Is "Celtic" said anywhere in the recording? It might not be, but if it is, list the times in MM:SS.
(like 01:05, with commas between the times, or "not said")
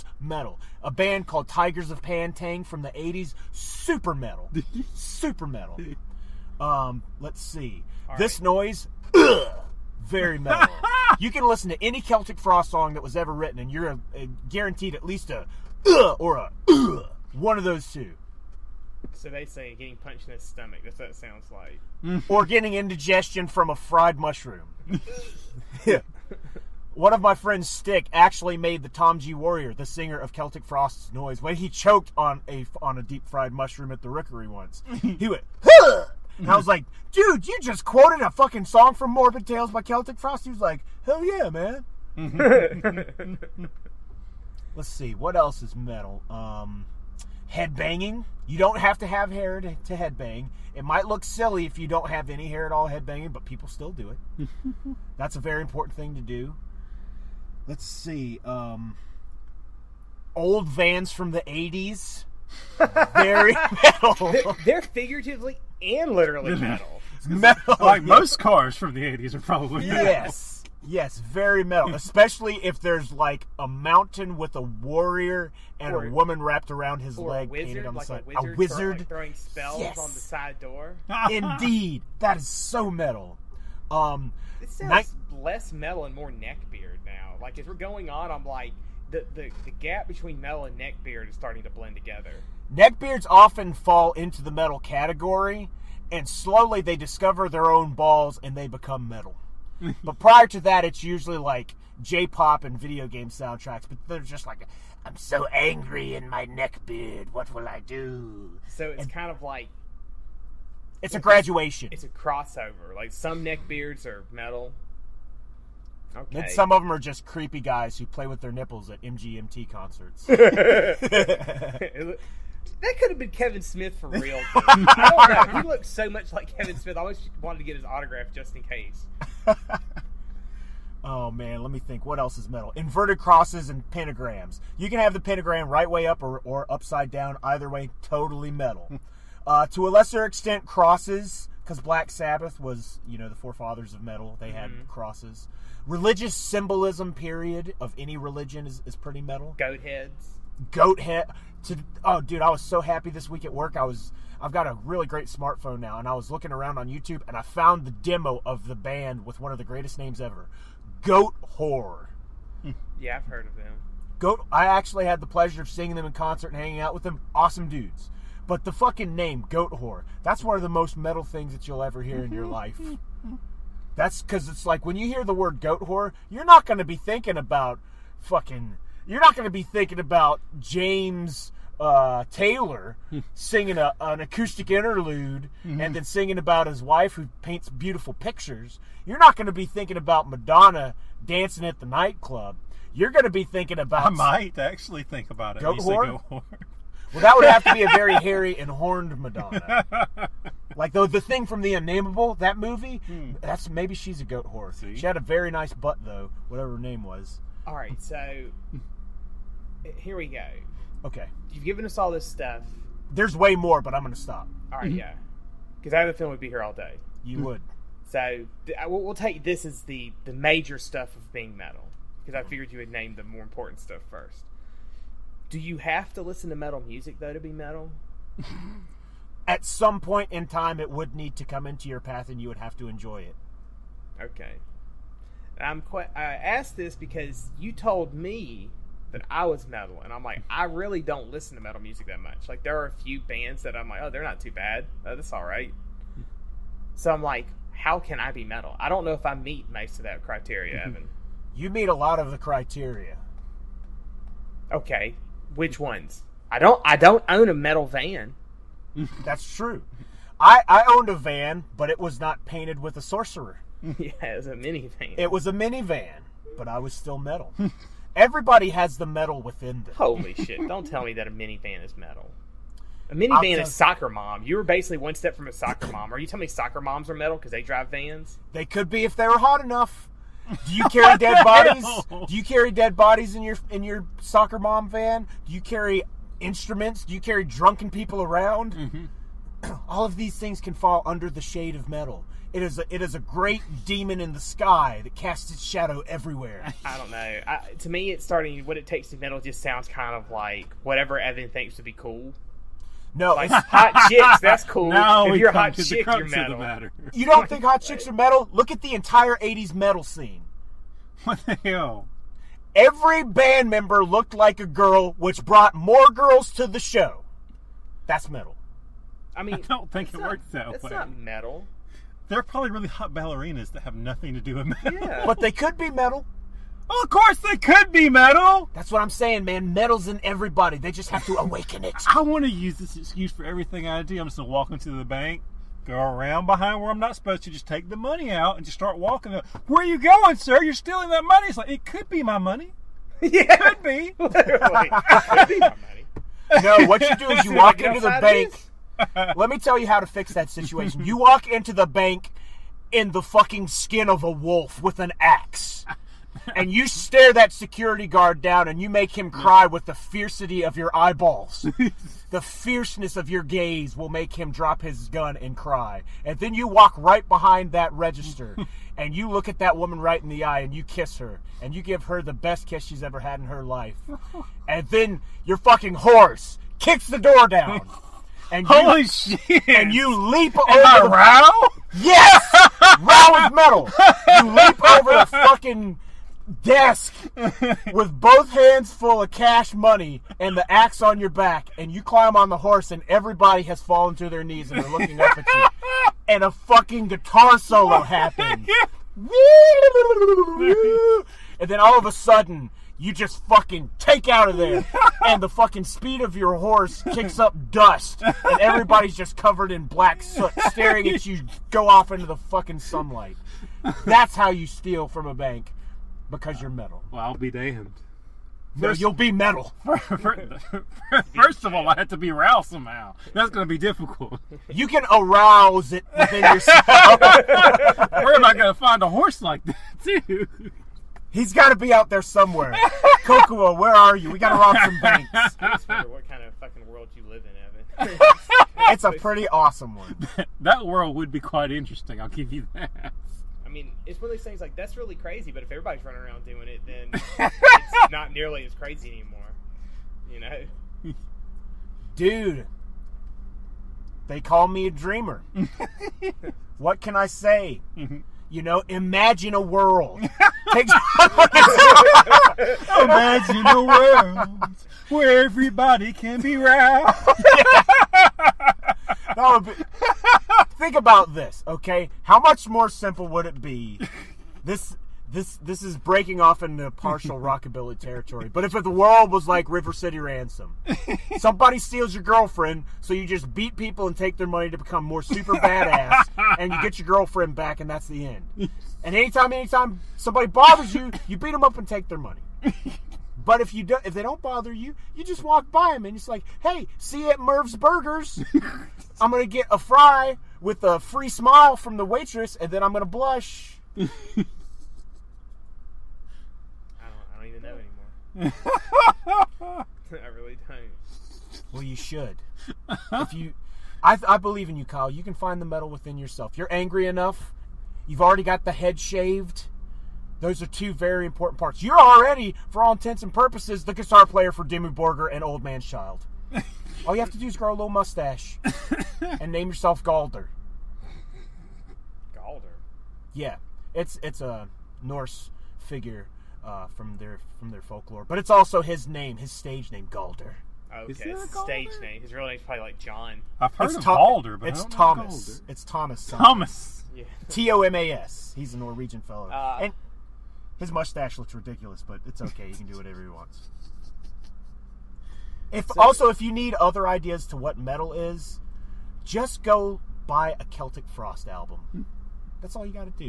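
00:12, 00:30, 00:39, 09:20.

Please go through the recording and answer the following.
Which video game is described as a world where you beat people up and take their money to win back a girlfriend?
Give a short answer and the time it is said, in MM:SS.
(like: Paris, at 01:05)
River City Ransom, at 07:59.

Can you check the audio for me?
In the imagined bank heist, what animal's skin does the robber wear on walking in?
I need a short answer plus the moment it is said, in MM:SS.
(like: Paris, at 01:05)
Wolf, at 05:54.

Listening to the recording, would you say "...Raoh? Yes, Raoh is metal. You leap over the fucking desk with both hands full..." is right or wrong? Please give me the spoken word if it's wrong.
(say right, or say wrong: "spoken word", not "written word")
right.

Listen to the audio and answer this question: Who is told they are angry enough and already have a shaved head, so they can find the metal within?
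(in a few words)
Kyle.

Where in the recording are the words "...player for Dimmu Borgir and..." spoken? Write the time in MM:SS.
08:44.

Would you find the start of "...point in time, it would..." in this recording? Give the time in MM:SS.
03:49.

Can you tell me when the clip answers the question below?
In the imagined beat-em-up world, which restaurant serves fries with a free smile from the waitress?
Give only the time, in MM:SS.
08:17.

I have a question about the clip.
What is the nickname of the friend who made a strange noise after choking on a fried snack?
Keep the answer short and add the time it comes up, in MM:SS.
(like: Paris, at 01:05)
Stick, at 00:27.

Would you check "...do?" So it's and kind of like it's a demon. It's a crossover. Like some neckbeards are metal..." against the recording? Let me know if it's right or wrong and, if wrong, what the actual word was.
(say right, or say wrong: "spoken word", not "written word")
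wrong: "graduation", not "demon".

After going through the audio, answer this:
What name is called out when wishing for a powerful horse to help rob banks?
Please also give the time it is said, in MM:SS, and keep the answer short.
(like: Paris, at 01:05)
Kokua, at 07:13.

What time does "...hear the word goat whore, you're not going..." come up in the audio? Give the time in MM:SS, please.
02:55.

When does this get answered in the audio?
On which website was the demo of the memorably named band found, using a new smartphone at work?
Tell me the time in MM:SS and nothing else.
02:36.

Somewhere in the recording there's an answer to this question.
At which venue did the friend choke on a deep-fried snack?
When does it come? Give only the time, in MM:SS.
00:34.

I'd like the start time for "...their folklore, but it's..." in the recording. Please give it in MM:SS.
08:57.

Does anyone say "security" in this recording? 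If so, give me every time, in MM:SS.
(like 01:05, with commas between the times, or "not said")
05:57.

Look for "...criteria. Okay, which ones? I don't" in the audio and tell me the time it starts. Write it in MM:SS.
04:12.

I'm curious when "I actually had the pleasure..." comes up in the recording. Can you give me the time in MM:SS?
02:44.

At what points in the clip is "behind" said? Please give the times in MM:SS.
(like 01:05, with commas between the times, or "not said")
05:36, 06:07.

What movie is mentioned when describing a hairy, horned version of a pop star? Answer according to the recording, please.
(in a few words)
The Unnameable.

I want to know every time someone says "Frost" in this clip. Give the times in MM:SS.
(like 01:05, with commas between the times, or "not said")
00:12, 00:30, 00:40, 09:21.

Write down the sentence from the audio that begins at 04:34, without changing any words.
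You were basically one step from a soccer mom.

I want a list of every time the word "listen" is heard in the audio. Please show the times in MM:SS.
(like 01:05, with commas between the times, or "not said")
00:11, 03:46, 04:01.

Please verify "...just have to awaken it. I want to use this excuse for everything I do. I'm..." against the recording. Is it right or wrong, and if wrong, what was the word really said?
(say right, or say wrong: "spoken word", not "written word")
right.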